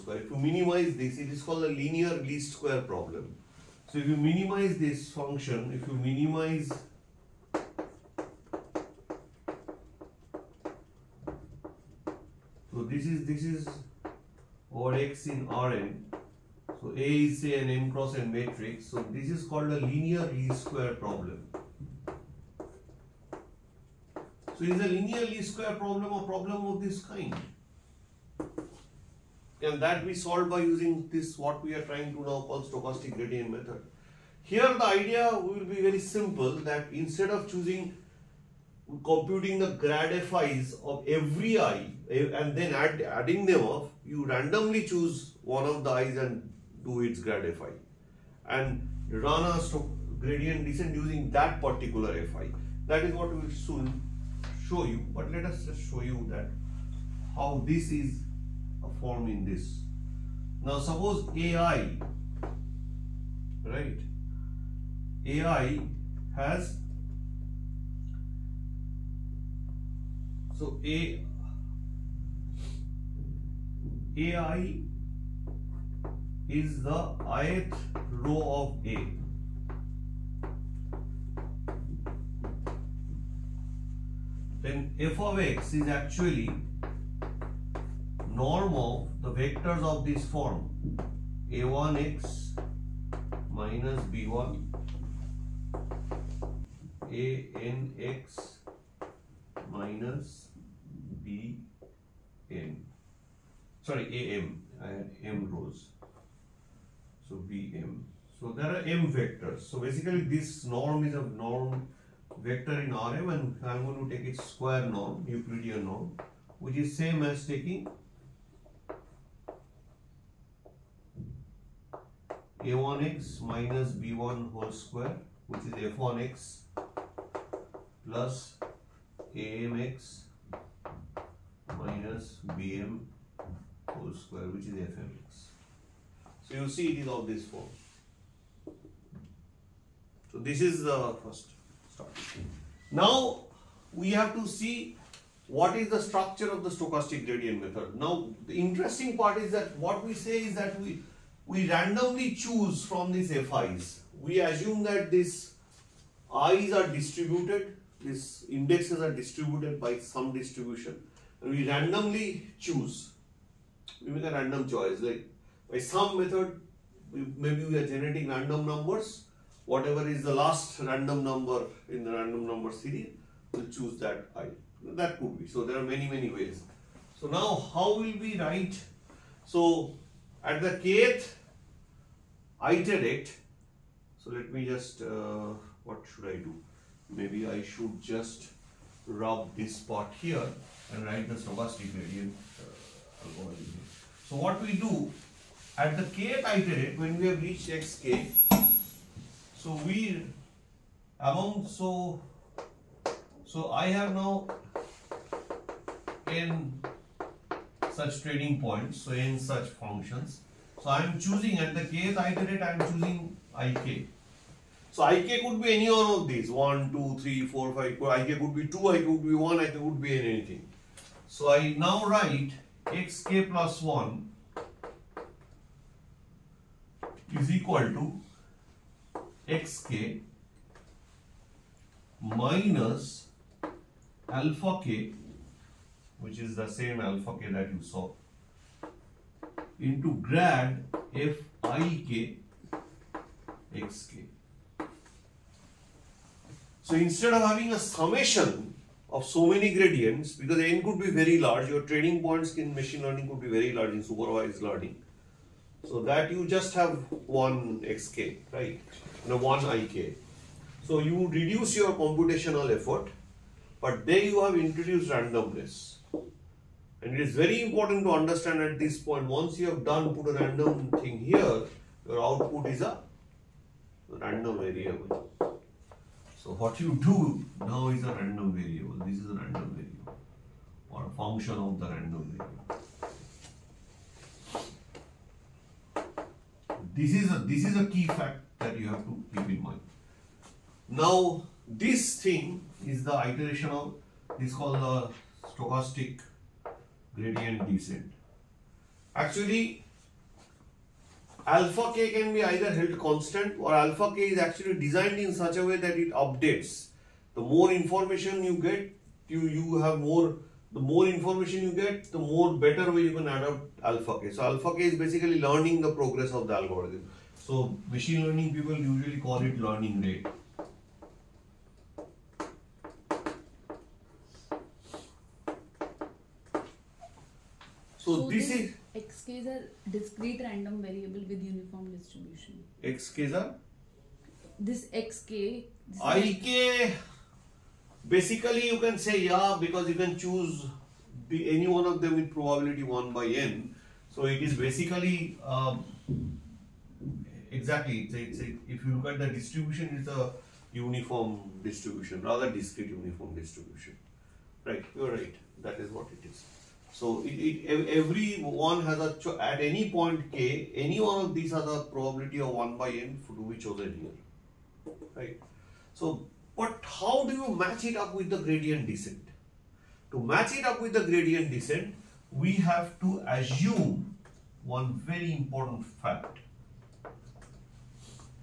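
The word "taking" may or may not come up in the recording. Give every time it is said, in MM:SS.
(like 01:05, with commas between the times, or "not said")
01:57.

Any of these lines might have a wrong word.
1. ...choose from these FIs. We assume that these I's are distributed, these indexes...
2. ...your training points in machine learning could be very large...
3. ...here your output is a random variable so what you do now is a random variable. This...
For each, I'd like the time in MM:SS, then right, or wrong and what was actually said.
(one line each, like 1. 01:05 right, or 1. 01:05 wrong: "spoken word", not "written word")
1. 02:32 right
2. 04:11 right
3. 04:31 right.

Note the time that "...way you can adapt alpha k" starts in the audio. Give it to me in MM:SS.
05:12.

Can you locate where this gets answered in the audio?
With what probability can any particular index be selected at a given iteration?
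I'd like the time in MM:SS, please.
06:02.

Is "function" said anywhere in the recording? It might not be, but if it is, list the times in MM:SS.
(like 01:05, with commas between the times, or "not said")
00:05, 03:29, 04:41.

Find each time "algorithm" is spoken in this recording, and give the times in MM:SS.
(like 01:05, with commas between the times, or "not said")
05:16.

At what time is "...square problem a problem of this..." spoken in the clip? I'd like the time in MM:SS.
00:25.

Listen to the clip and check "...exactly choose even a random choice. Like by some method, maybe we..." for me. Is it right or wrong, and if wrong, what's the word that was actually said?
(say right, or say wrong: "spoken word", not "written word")
wrong: "randomly", not "exactly".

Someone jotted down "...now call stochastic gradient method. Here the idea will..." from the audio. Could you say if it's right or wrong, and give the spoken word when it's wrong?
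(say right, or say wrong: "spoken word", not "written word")
right.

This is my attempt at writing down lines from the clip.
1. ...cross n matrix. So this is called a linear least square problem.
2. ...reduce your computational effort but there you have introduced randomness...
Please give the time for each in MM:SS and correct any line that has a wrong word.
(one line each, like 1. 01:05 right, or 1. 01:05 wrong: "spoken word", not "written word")
1. 00:17 right
2. 04:21 right.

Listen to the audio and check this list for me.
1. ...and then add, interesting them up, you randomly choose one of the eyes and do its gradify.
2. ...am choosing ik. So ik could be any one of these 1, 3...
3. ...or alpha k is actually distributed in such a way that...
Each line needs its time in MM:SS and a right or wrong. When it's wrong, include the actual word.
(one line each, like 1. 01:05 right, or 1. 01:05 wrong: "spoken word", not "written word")
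1. 00:42 wrong: "adding", not "interesting"
2. 03:32 wrong: "2", not "3"
3. 05:03 wrong: "designed", not "distributed".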